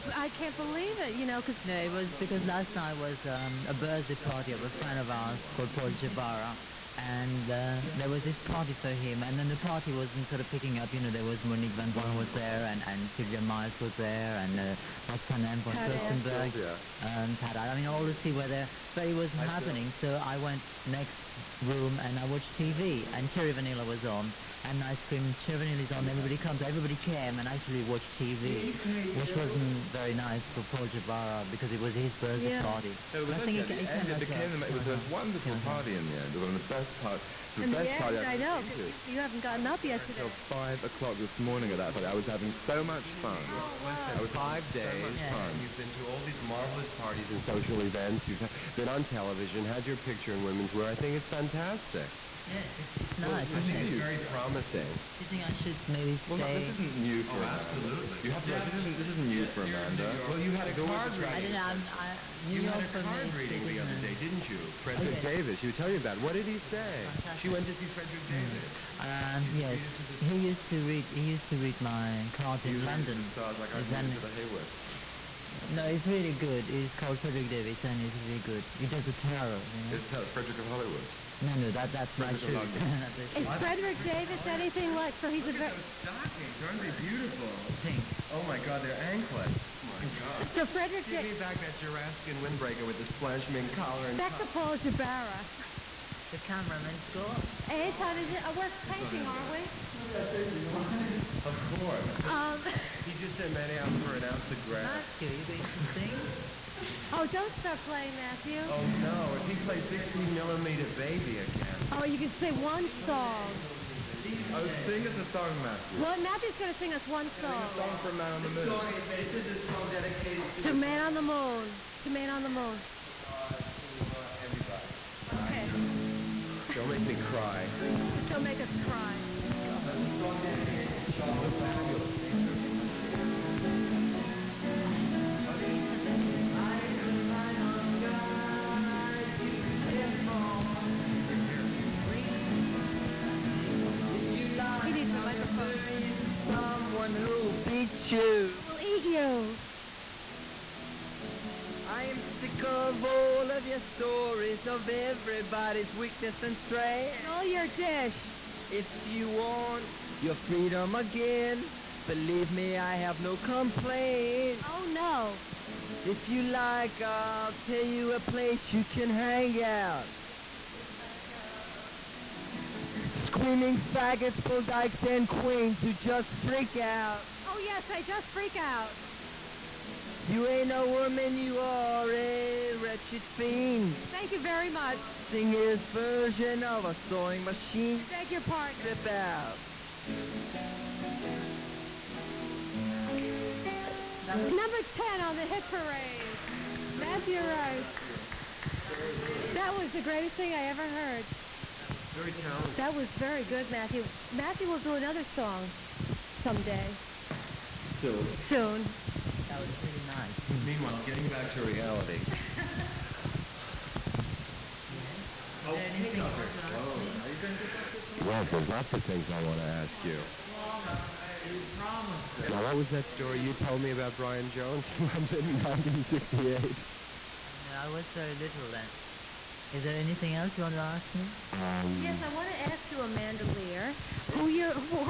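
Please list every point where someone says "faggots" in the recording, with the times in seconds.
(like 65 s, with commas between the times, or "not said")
173 s.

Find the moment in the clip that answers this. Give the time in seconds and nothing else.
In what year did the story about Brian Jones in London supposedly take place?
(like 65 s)
225 s.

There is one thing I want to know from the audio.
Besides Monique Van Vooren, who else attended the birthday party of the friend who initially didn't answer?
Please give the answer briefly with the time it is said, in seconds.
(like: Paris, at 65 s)
Sylvia Miles, at 13 s.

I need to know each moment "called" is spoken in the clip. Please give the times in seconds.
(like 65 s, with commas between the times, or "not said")
5 s, 76 s.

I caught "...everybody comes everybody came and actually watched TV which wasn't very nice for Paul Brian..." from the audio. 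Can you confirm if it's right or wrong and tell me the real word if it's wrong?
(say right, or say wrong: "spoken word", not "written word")
wrong: "Jabara", not "Brian".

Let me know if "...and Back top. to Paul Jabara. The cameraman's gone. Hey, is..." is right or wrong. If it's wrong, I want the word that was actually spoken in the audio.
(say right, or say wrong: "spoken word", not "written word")
right.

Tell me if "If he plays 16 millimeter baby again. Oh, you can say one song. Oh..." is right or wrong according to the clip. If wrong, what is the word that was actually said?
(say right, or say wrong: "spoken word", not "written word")
right.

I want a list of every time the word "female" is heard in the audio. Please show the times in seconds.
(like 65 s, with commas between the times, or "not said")
not said.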